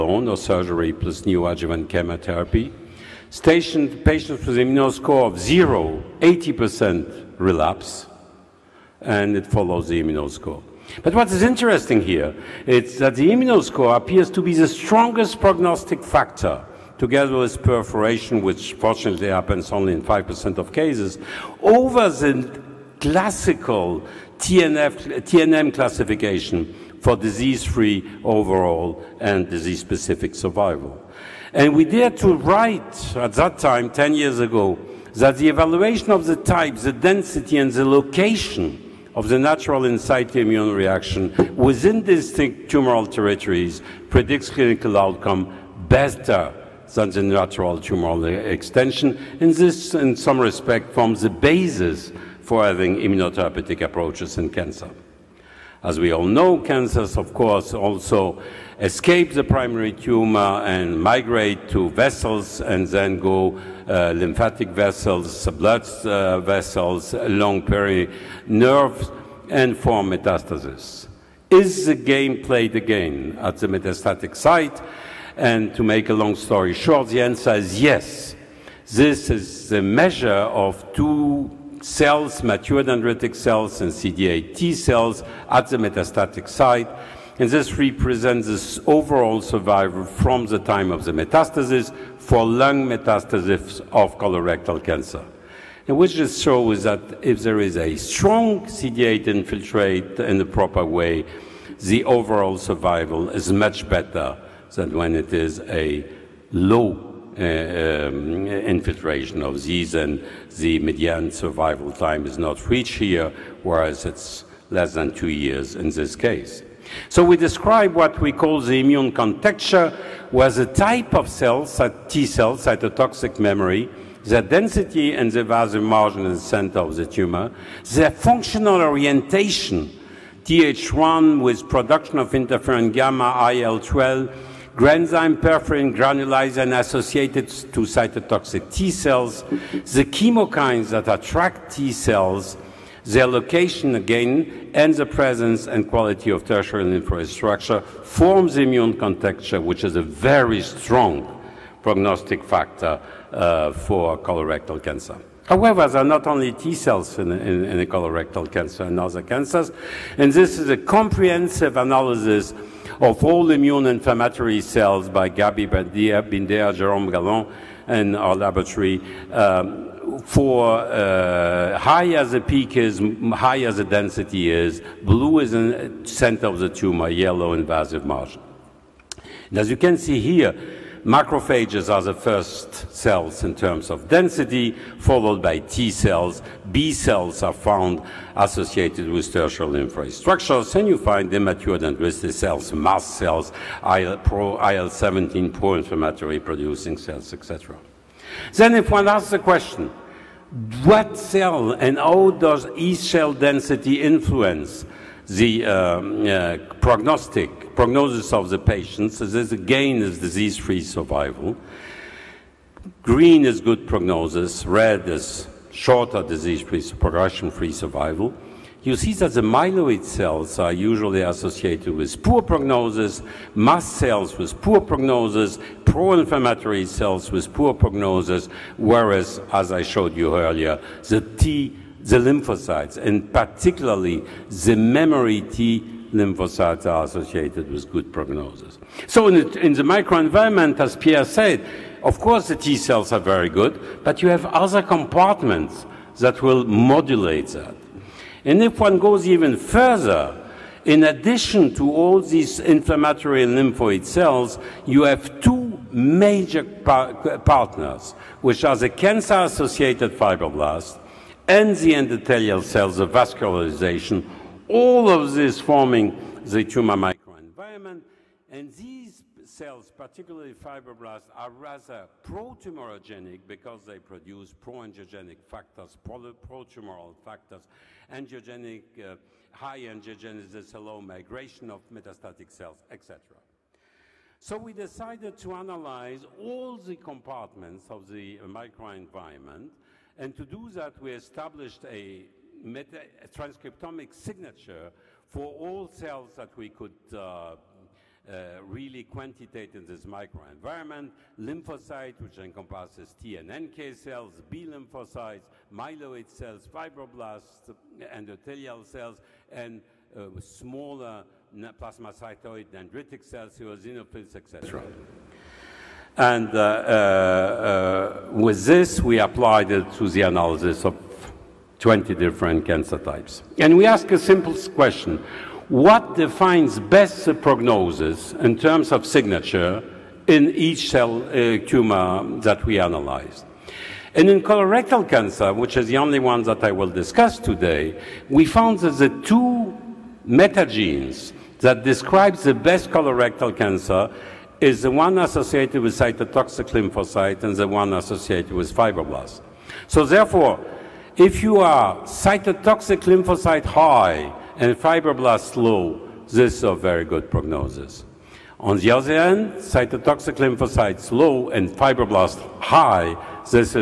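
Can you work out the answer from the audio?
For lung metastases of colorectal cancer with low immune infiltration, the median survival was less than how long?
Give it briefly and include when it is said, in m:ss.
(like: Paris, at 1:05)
2 years, at 1:55.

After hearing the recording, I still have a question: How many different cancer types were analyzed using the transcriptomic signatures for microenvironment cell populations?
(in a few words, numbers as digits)
20.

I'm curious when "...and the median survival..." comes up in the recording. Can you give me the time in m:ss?
1:49.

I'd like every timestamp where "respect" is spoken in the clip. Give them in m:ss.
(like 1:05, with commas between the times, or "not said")
0:50.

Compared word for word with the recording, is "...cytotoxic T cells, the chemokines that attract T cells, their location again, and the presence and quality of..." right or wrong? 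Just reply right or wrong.
right.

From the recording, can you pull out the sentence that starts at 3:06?
B cells are found associated with tertiary infrastructures, and you find immature dendritic cells, mast cells, IL-17 pro-inflammatory producing cells, etc.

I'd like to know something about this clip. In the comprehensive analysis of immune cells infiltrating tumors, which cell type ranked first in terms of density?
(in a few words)
Macrophages.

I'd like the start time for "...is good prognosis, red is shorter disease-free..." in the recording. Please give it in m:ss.
3:33.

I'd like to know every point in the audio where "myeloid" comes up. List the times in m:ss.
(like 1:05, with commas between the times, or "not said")
3:39, 5:05.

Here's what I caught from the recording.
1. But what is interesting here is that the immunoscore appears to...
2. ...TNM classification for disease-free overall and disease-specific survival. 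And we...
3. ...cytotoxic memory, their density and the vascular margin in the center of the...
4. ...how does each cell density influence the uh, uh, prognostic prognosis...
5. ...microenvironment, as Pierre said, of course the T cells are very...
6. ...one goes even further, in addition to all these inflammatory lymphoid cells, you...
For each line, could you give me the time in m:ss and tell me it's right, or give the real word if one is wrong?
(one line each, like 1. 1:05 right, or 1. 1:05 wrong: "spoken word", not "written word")
1. 0:11 right
2. 0:25 right
3. 2:02 right
4. 3:21 right
5. 3:59 right
6. 4:08 right.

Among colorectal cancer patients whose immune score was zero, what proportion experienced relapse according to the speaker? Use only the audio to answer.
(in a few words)
80%.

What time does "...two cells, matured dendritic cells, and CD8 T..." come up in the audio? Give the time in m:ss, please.
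1:20.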